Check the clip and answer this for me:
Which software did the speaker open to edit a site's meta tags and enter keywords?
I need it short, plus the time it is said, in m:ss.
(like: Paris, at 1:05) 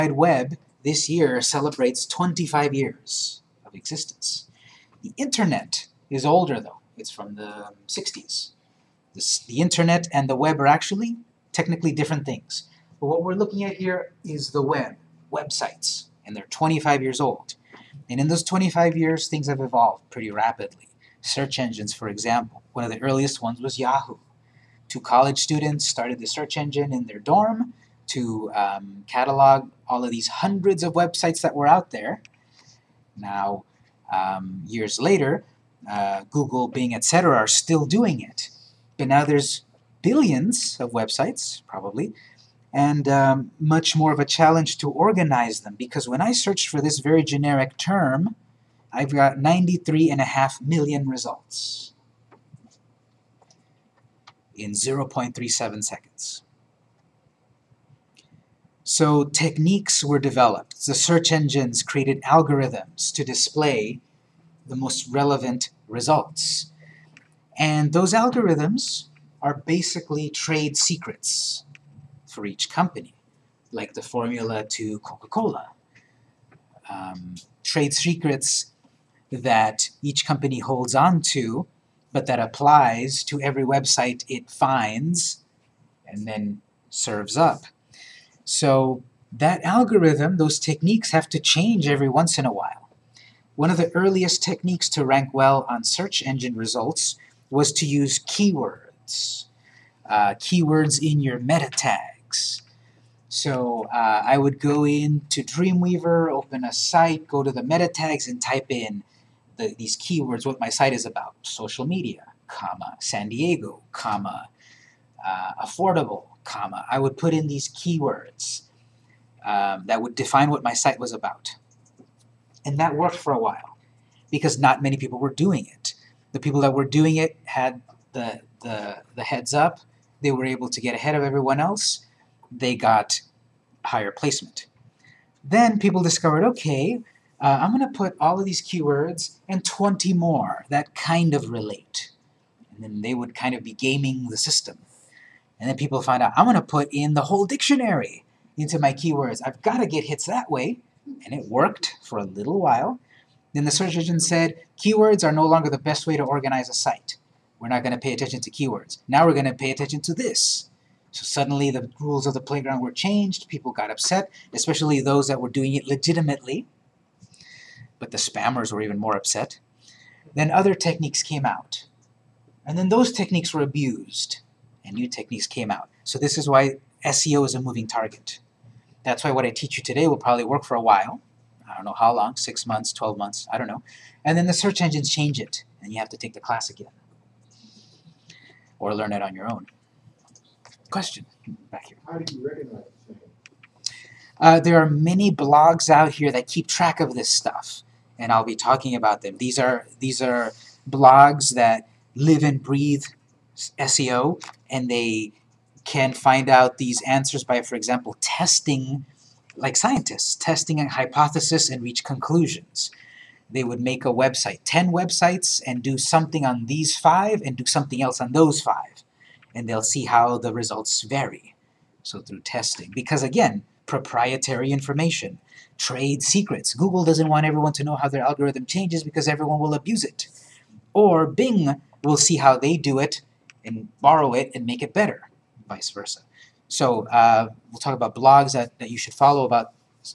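Dreamweaver, at 1:45.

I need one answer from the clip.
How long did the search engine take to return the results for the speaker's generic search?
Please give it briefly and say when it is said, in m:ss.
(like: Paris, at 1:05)
0.37 seconds, at 0:54.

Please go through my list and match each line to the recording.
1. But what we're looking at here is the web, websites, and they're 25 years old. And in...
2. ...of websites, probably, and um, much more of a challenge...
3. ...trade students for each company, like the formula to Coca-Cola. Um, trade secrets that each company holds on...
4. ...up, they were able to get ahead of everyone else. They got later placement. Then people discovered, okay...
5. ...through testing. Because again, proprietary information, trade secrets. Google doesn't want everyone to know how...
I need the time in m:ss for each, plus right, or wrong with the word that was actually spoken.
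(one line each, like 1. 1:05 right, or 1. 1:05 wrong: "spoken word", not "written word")
1. 0:12 right
2. 0:40 right
3. 1:10 wrong: "secrets", not "students"
4. 2:09 wrong: "higher", not "later"
5. 3:42 right.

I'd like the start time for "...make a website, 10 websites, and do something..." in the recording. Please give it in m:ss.
3:33.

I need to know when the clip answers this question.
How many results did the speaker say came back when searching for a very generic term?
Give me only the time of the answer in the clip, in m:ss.
0:49.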